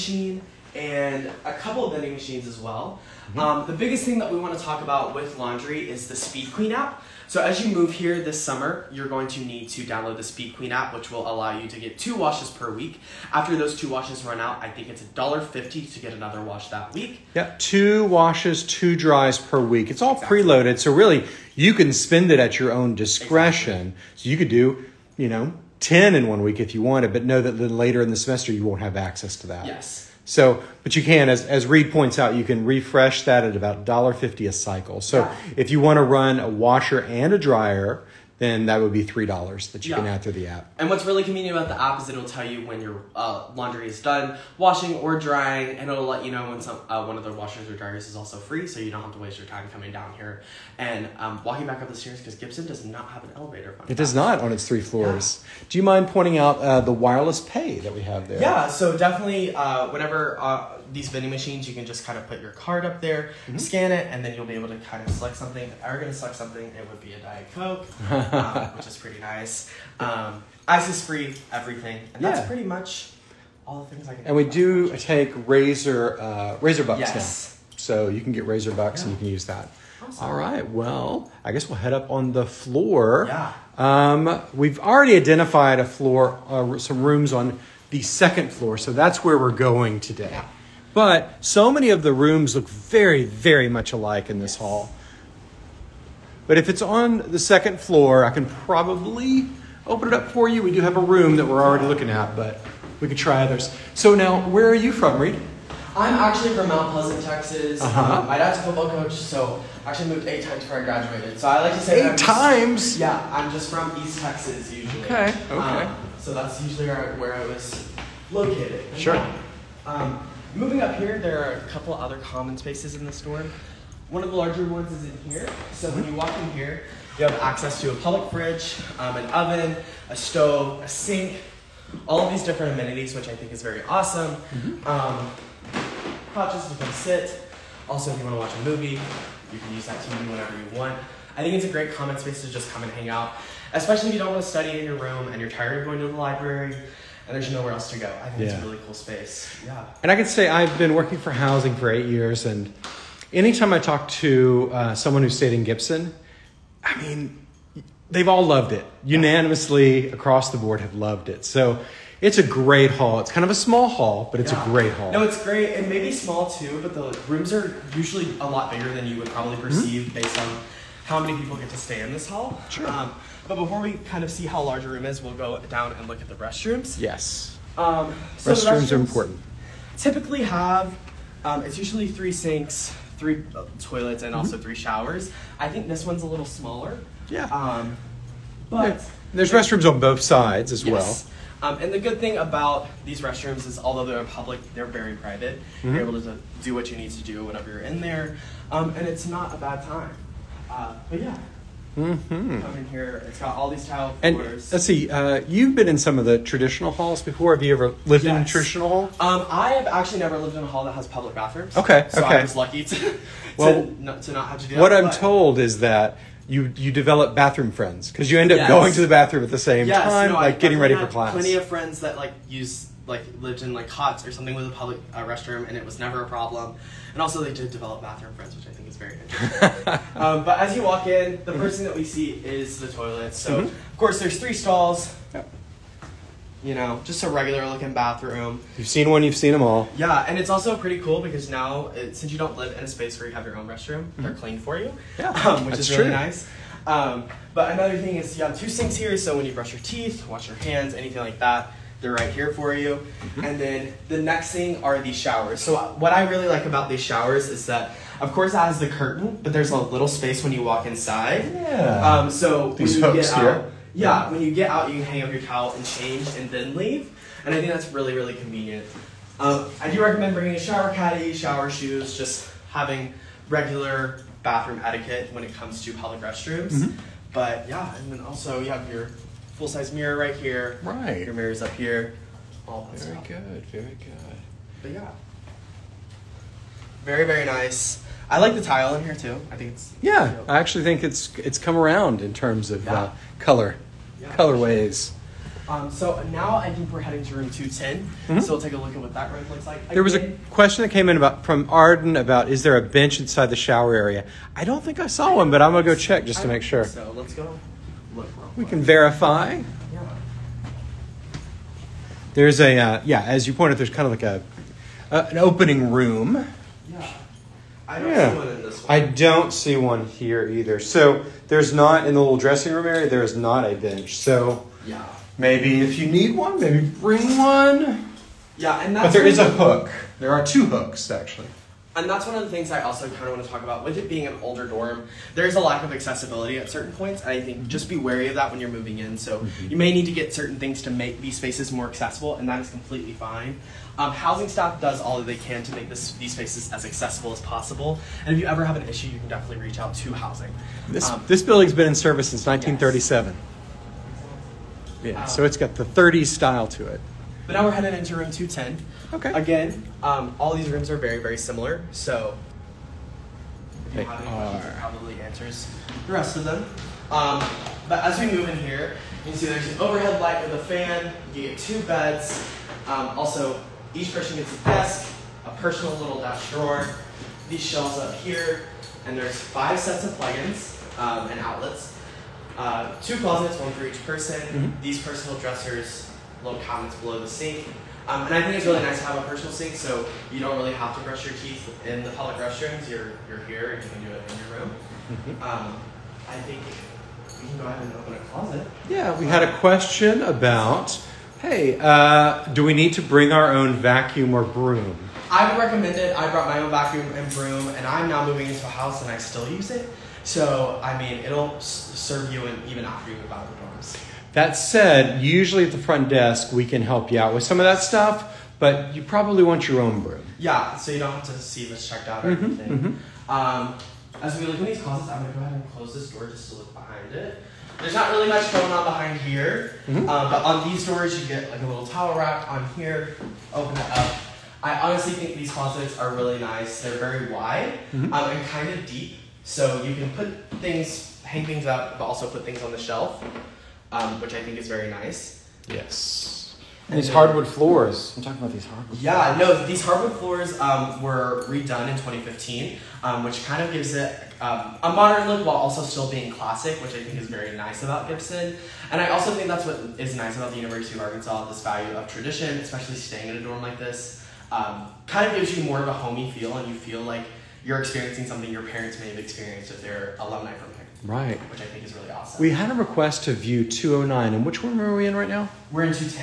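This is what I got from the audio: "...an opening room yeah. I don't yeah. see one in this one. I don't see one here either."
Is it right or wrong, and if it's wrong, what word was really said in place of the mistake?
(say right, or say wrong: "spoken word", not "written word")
right.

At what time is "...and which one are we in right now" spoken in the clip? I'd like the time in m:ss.
7:54.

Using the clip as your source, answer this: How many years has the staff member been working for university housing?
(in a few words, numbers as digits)
8.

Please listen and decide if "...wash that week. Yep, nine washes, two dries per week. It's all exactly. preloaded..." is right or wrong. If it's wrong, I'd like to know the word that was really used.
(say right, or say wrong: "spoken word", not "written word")
wrong: "two", not "nine".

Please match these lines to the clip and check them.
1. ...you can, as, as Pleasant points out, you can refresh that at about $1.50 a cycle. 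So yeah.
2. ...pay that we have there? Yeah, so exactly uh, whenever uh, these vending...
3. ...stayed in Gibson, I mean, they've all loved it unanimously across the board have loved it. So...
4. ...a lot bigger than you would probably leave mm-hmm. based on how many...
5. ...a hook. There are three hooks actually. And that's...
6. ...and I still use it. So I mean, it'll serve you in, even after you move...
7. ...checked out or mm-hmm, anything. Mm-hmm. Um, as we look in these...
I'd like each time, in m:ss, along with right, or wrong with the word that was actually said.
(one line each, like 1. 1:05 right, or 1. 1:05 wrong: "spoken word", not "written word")
1. 0:30 wrong: "Reed", not "Pleasant"
2. 0:57 wrong: "definitely", not "exactly"
3. 2:35 right
4. 2:48 wrong: "perceive", not "leave"
5. 5:29 wrong: "two", not "three"
6. 6:49 right
7. 7:01 right.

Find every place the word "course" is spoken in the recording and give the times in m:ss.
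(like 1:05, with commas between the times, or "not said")
3:53, 4:18.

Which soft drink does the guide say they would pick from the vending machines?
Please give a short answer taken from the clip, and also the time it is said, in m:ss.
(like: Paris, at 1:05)
Diet Coke, at 1:07.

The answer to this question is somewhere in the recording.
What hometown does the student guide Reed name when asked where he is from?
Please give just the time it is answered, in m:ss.
1:46.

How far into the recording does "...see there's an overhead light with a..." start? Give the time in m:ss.
6:09.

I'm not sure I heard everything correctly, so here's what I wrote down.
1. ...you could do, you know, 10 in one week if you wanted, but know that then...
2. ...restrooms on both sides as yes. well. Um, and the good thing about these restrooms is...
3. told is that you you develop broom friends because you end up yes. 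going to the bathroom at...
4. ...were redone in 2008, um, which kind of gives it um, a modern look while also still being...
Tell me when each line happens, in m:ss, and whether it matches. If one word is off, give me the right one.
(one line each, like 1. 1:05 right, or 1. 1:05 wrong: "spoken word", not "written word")
1. 0:24 right
2. 3:09 right
3. 3:35 wrong: "bathroom", not "broom"
4. 7:31 wrong: "2015", not "2008".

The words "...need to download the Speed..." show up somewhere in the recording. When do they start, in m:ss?
0:09.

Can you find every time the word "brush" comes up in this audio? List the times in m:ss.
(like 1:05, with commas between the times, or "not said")
4:09, 6:31.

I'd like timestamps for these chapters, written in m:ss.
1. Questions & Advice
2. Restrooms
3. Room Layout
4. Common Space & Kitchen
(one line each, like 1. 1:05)
1. 6:38
2. 2:55
3. 5:55
4. 2:00.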